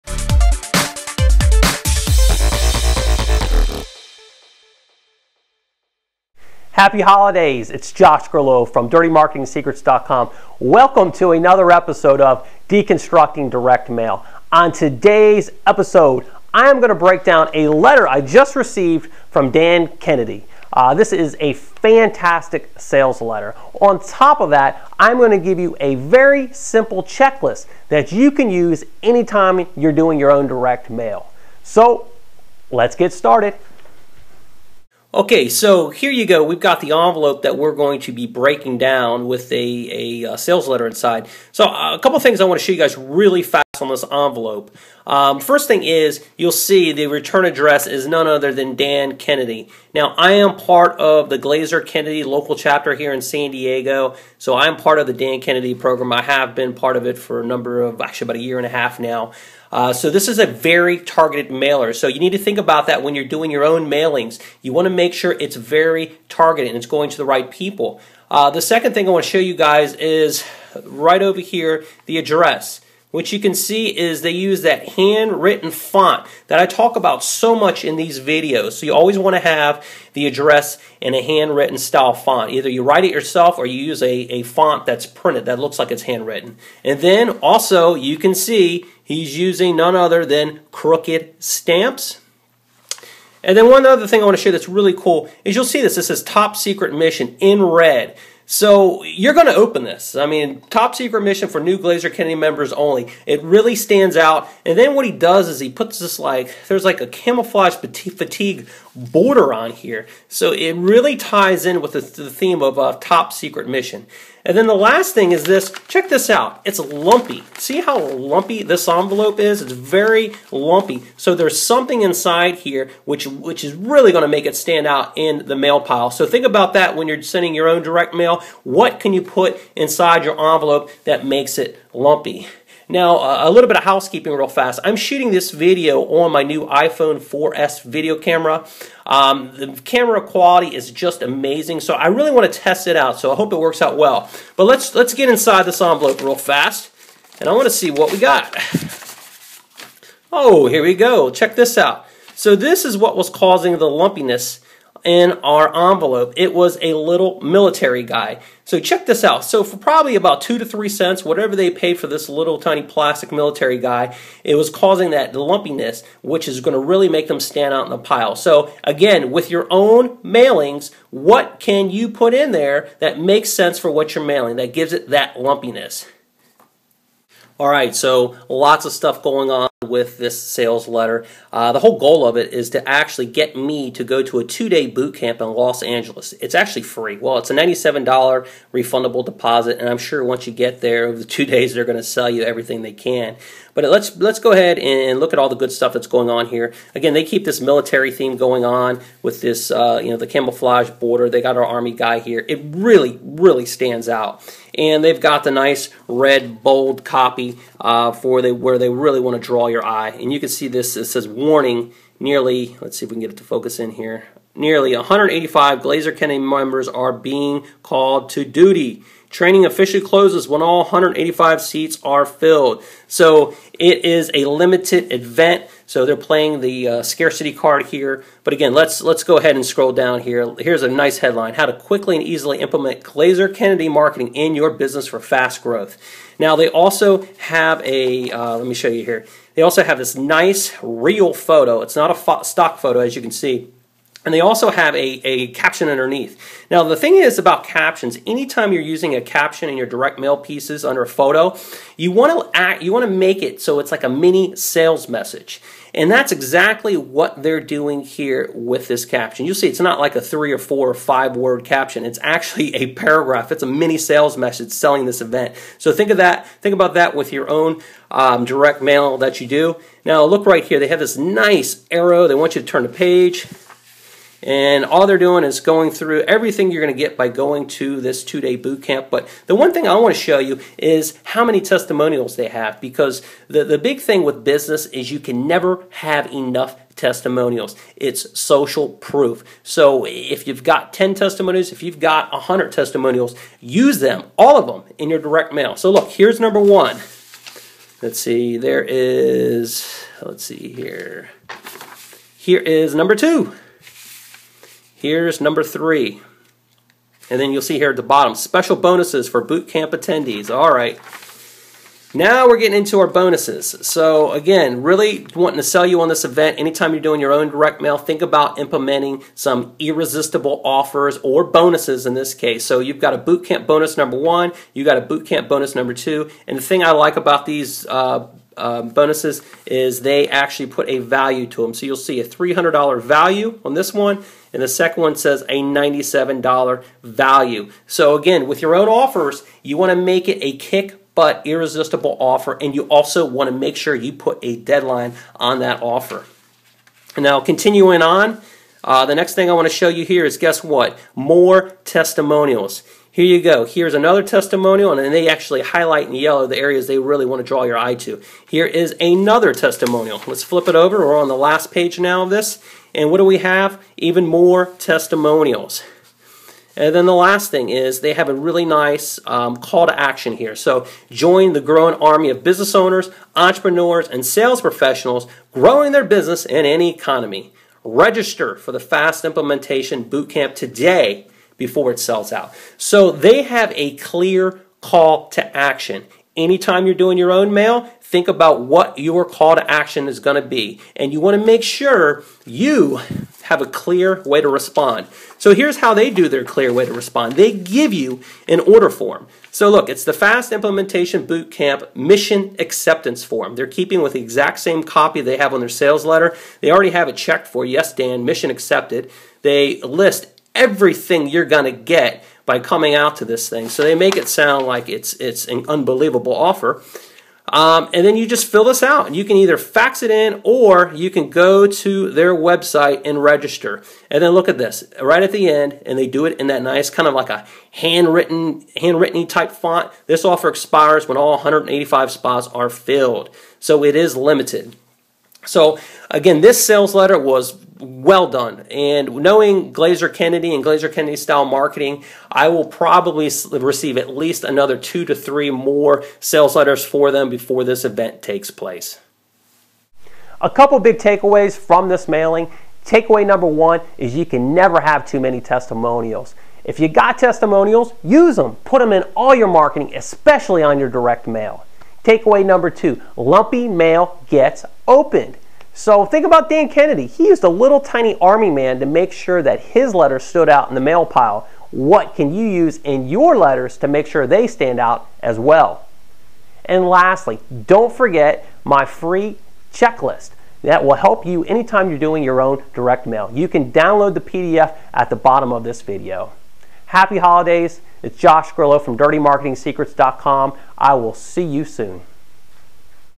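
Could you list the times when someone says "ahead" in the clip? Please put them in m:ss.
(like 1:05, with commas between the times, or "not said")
3:14, 3:49.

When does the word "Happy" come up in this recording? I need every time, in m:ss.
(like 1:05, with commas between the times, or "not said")
0:06, 8:06.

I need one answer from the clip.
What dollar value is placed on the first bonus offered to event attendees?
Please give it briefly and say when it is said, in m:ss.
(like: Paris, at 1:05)
$300, at 5:32.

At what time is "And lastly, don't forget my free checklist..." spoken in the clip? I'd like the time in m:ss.
7:56.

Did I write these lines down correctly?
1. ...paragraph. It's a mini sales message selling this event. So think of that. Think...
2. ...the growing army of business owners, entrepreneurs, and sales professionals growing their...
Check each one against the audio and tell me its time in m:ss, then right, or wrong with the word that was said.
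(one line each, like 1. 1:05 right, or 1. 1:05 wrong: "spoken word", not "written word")
1. 4:22 right
2. 6:11 right.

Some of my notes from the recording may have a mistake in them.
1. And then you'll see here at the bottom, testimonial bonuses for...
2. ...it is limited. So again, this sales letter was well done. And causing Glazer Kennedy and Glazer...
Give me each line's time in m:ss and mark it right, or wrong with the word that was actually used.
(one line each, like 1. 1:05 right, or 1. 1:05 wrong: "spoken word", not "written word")
1. 5:07 wrong: "special", not "testimonial"
2. 7:13 wrong: "knowing", not "causing".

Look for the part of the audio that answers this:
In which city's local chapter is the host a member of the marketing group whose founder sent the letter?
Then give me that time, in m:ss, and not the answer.
0:53.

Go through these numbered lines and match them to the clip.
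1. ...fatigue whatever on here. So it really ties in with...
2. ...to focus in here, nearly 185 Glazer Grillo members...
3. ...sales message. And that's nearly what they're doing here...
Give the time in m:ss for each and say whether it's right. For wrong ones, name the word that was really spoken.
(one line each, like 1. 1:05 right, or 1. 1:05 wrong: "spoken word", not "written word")
1. 1:47 wrong: "border", not "whatever"
2. 3:33 wrong: "Kennedy", not "Grillo"
3. 4:14 wrong: "exactly", not "nearly".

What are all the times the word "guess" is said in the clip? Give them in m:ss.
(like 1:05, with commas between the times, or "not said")
5:50.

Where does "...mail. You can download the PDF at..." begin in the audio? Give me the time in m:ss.
8:03.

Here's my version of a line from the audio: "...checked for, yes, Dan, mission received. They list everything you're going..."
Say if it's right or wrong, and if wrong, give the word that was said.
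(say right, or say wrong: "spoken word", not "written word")
wrong: "accepted", not "received".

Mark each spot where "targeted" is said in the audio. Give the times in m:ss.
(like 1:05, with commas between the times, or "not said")
1:00, 1:06.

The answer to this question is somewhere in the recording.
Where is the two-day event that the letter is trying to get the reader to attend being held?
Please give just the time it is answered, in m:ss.
3:05.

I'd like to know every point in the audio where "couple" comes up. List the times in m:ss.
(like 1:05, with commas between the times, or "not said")
0:41, 7:30.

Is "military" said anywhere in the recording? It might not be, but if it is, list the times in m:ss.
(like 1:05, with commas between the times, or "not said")
2:37, 2:43, 3:17.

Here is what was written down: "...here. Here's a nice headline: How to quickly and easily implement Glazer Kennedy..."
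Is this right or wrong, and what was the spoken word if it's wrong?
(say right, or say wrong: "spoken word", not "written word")
right.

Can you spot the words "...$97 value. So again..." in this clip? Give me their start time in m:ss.
5:35.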